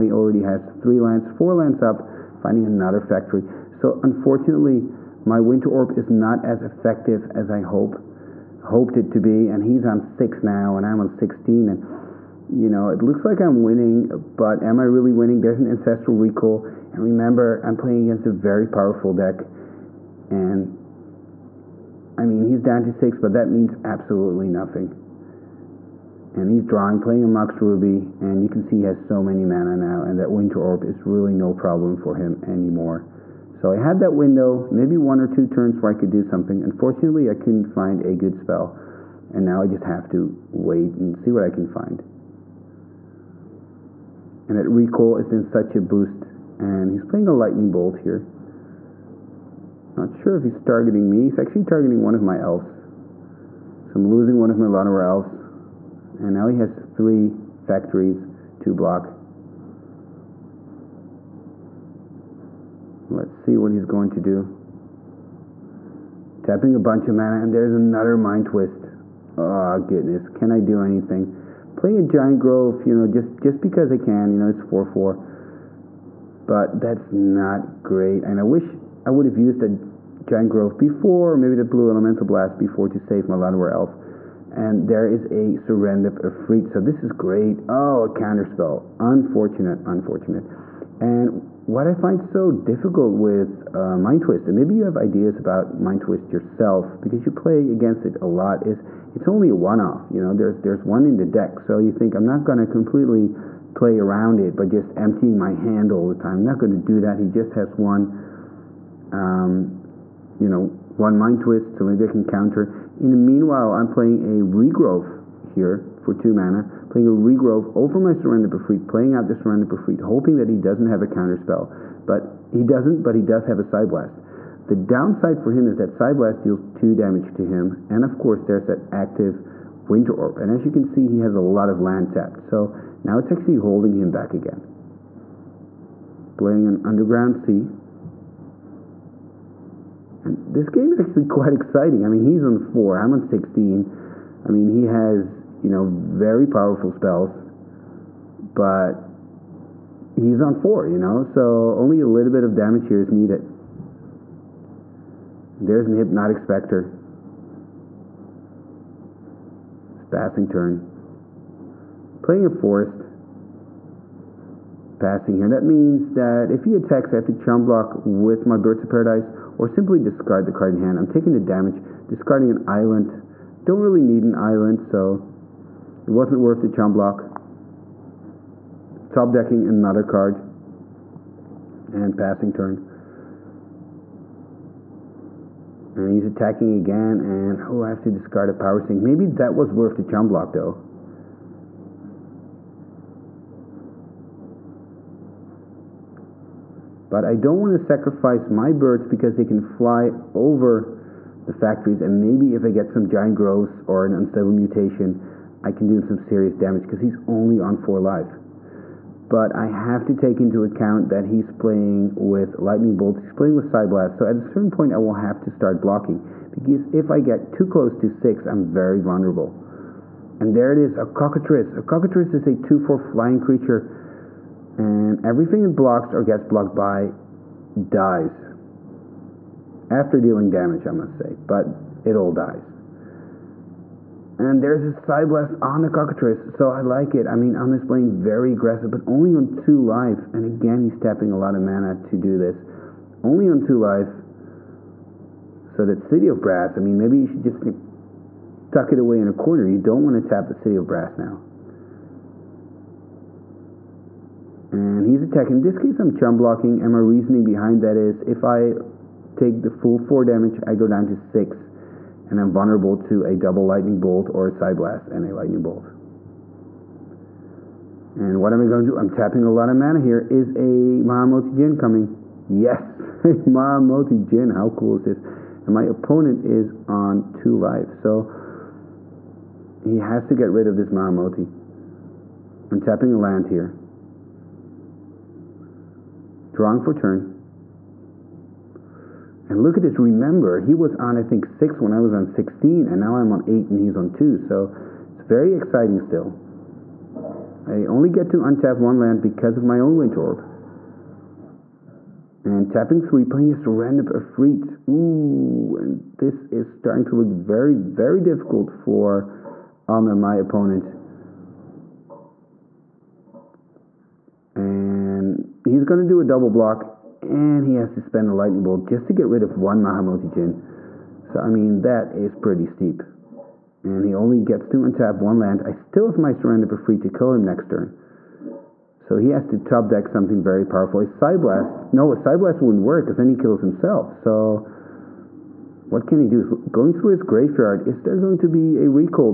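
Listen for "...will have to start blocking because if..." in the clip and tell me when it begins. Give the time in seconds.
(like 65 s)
214 s.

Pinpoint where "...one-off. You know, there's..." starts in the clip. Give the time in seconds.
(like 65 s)
99 s.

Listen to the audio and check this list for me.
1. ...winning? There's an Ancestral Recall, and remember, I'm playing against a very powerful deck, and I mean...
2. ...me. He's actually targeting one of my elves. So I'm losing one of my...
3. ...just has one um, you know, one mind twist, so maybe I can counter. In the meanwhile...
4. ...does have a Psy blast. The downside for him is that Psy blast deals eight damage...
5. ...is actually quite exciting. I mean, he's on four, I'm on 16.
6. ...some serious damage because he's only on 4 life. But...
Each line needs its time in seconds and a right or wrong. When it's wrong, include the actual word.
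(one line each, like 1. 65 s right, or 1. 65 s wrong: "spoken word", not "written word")
1. 15 s right
2. 51 s right
3. 107 s right
4. 123 s wrong: "two", not "eight"
5. 140 s right
6. 206 s right.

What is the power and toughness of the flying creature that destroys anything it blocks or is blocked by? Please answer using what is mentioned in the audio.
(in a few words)
2/4.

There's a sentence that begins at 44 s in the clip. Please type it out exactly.
And that Recall is in such a boost, and he's playing a Lightning Bolt here.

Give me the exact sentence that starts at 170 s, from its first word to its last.
I'm taking the damage, discarding an island.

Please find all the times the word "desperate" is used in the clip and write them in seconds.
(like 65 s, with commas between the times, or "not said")
not said.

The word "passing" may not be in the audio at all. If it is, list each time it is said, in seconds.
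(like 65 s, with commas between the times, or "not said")
160 s, 165 s, 182 s.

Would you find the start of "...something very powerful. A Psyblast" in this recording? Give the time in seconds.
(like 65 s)
330 s.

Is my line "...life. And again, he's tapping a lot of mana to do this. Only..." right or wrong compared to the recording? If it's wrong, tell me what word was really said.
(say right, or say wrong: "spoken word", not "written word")
right.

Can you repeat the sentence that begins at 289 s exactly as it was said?
Remember, he was on, I think, 6 when I was on 16, and now I'm on 8 and he's on 2.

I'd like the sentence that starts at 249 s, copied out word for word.
You don't want to tap the City of Brass now.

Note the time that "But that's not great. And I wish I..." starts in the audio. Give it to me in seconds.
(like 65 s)
76 s.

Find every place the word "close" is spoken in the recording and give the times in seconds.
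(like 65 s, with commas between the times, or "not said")
217 s.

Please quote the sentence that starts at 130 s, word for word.
And as you can see, he has a lot of land tapped, so now it's actually holding him back again.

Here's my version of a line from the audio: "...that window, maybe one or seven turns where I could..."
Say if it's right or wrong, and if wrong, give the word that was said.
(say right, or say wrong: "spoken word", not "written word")
wrong: "two", not "seven".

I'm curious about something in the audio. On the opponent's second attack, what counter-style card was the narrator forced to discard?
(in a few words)
Power Sink.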